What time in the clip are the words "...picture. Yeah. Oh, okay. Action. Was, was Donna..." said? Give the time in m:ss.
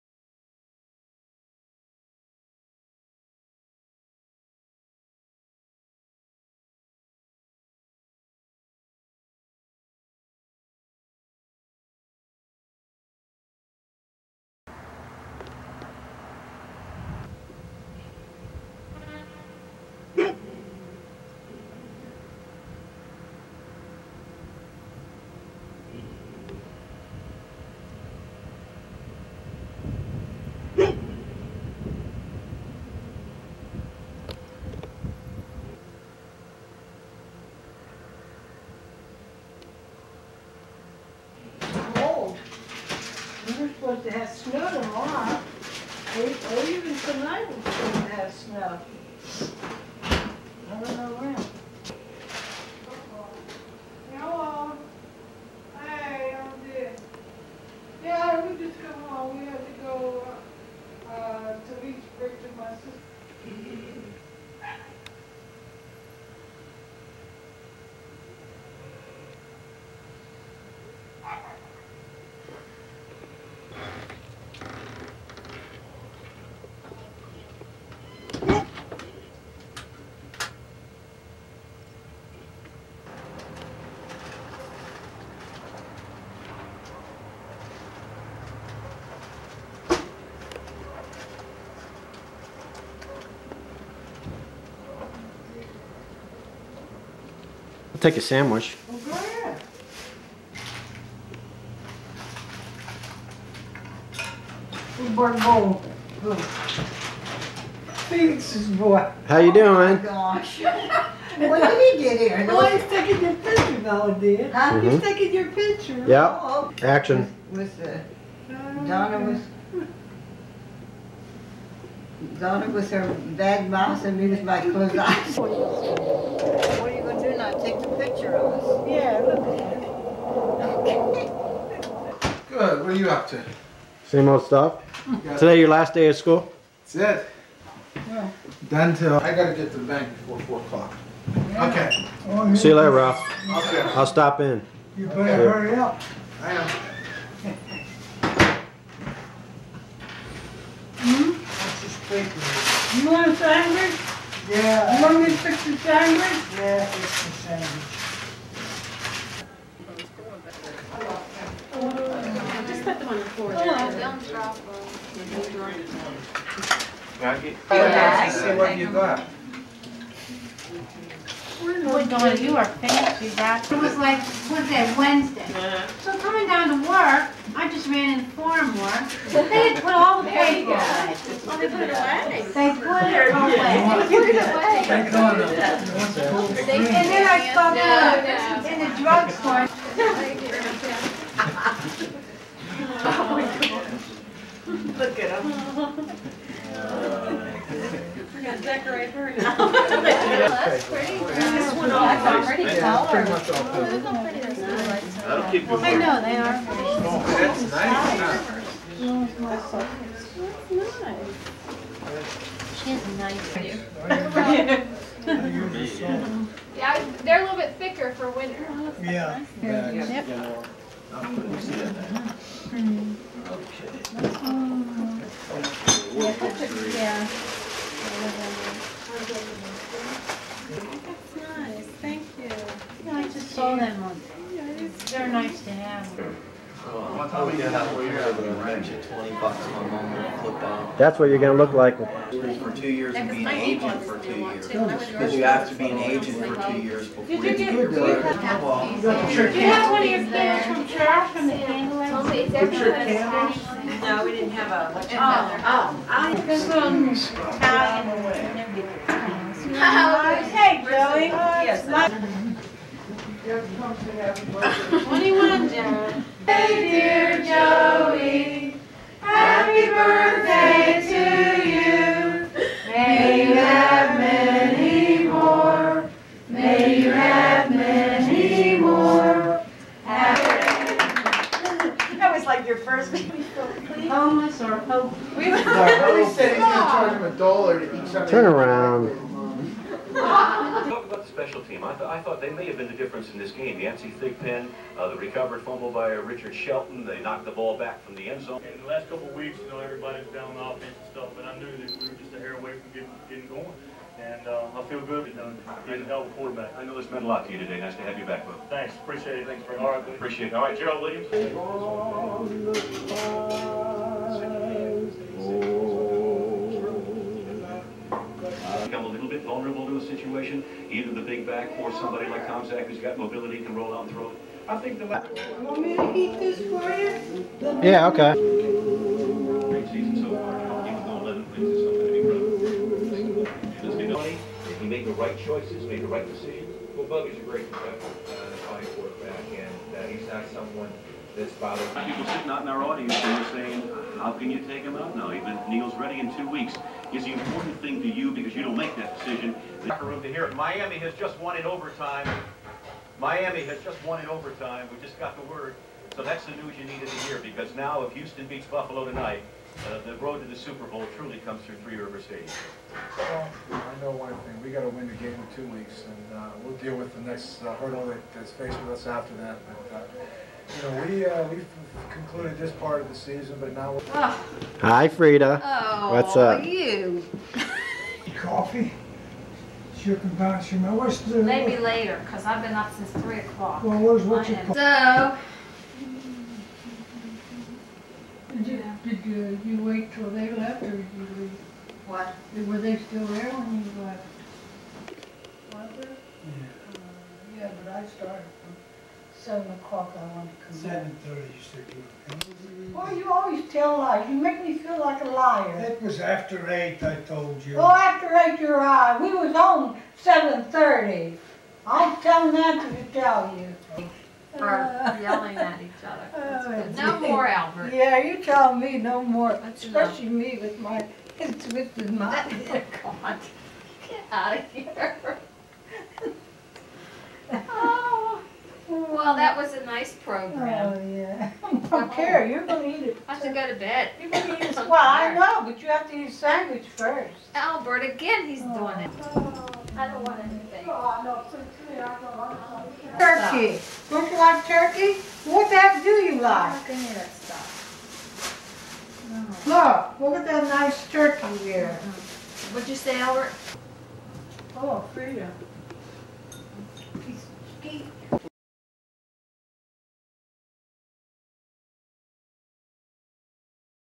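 1:55.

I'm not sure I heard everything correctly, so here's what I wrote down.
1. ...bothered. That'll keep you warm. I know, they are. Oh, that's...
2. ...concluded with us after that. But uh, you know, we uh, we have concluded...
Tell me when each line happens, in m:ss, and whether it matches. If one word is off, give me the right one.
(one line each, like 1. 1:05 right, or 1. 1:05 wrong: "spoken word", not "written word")
1. 3:23 wrong: "covered", not "bothered"
2. 6:08 wrong: "faced", not "concluded".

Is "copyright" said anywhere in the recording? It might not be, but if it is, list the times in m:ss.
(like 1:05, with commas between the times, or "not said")
not said.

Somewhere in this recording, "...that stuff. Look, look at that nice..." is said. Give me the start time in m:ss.
7:27.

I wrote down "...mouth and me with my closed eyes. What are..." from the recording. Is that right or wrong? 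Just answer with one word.
right.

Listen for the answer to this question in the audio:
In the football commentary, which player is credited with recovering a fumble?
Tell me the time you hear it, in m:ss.
4:56.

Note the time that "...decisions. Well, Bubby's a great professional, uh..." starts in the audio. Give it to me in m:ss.
5:36.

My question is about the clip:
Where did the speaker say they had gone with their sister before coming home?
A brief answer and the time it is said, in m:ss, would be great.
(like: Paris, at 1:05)
Leech Bridge, at 1:01.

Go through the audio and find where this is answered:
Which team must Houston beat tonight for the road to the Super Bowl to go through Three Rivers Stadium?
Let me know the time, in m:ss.
5:58.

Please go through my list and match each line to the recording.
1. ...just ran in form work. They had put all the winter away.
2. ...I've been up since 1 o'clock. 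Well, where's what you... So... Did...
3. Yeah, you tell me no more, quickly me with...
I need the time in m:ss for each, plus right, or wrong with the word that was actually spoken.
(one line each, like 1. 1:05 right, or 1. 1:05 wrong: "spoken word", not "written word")
1. 2:57 wrong: "paper", not "winter"
2. 6:22 wrong: "3", not "1"
3. 6:57 wrong: "especially", not "quickly".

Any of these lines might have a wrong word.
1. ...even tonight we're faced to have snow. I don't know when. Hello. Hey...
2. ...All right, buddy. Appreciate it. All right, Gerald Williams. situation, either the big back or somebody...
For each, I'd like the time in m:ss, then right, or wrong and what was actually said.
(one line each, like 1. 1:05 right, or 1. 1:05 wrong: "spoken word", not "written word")
1. 0:46 wrong: "supposed", not "faced"
2. 5:09 right.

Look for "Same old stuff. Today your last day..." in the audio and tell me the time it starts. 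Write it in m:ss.
2:14.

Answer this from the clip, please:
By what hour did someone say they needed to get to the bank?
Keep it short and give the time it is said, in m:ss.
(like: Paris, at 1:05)
4 o'clock, at 2:20.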